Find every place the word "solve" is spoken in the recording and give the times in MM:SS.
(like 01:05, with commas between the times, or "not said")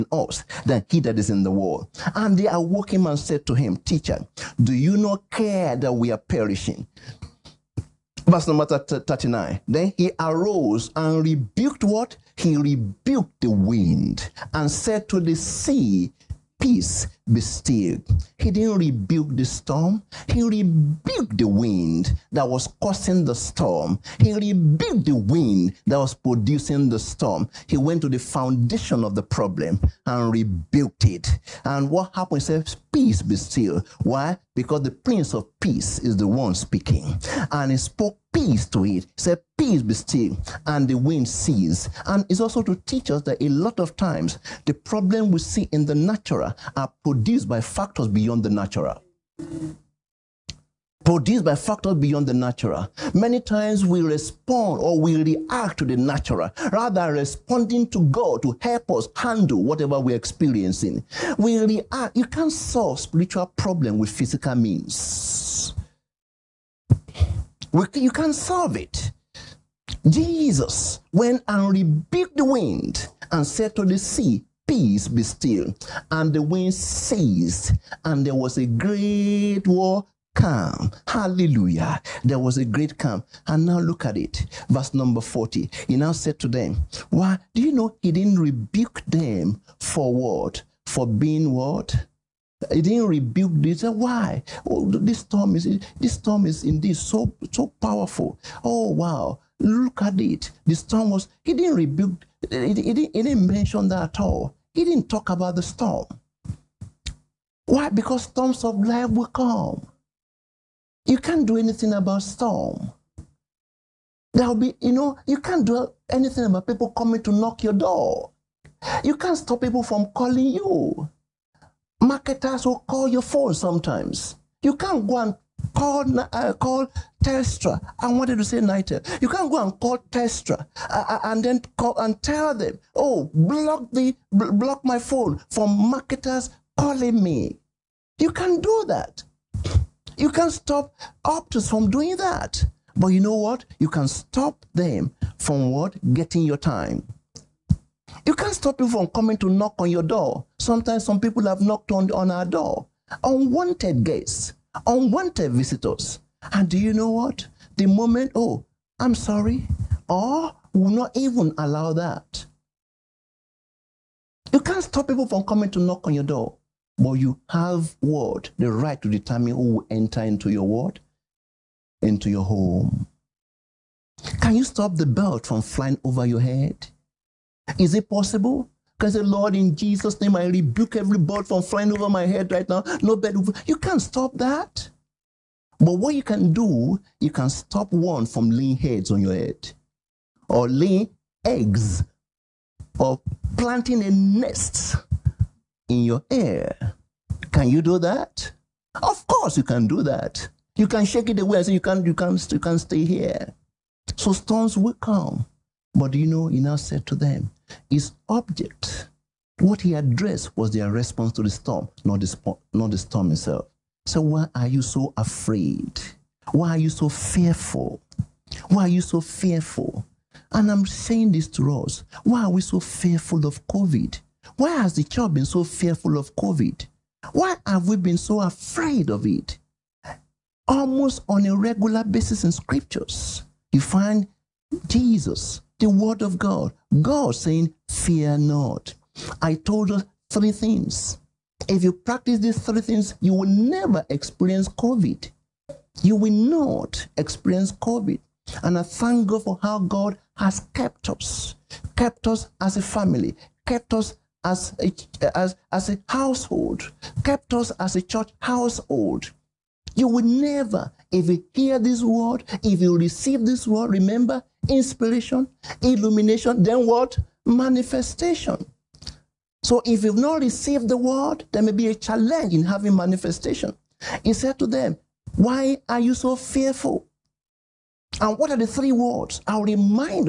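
01:02, 01:08.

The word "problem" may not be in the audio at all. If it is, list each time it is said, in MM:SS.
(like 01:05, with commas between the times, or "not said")
00:29, 00:44, 01:03.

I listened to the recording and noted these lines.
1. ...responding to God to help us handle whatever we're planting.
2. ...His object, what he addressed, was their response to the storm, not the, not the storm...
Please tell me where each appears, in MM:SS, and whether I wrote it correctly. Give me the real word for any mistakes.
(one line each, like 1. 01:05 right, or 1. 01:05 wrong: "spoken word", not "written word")
1. 00:57 wrong: "experiencing", not "planting"
2. 03:27 right.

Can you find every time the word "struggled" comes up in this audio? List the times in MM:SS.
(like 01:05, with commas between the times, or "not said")
not said.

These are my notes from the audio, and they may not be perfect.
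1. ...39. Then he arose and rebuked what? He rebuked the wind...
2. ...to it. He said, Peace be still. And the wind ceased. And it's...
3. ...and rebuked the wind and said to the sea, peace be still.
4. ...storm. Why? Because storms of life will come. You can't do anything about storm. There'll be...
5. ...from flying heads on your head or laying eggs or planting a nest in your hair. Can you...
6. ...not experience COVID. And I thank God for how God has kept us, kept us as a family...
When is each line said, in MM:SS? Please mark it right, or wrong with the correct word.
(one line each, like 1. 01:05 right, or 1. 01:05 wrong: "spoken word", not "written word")
1. 00:08 right
2. 00:38 right
3. 01:11 right
4. 01:45 right
5. 03:08 wrong: "laying", not "flying"
6. 04:06 right.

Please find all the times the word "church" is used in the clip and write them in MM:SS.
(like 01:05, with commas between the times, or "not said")
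03:45, 04:18.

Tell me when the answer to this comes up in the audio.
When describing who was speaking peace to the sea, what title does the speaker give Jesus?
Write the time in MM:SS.
00:34.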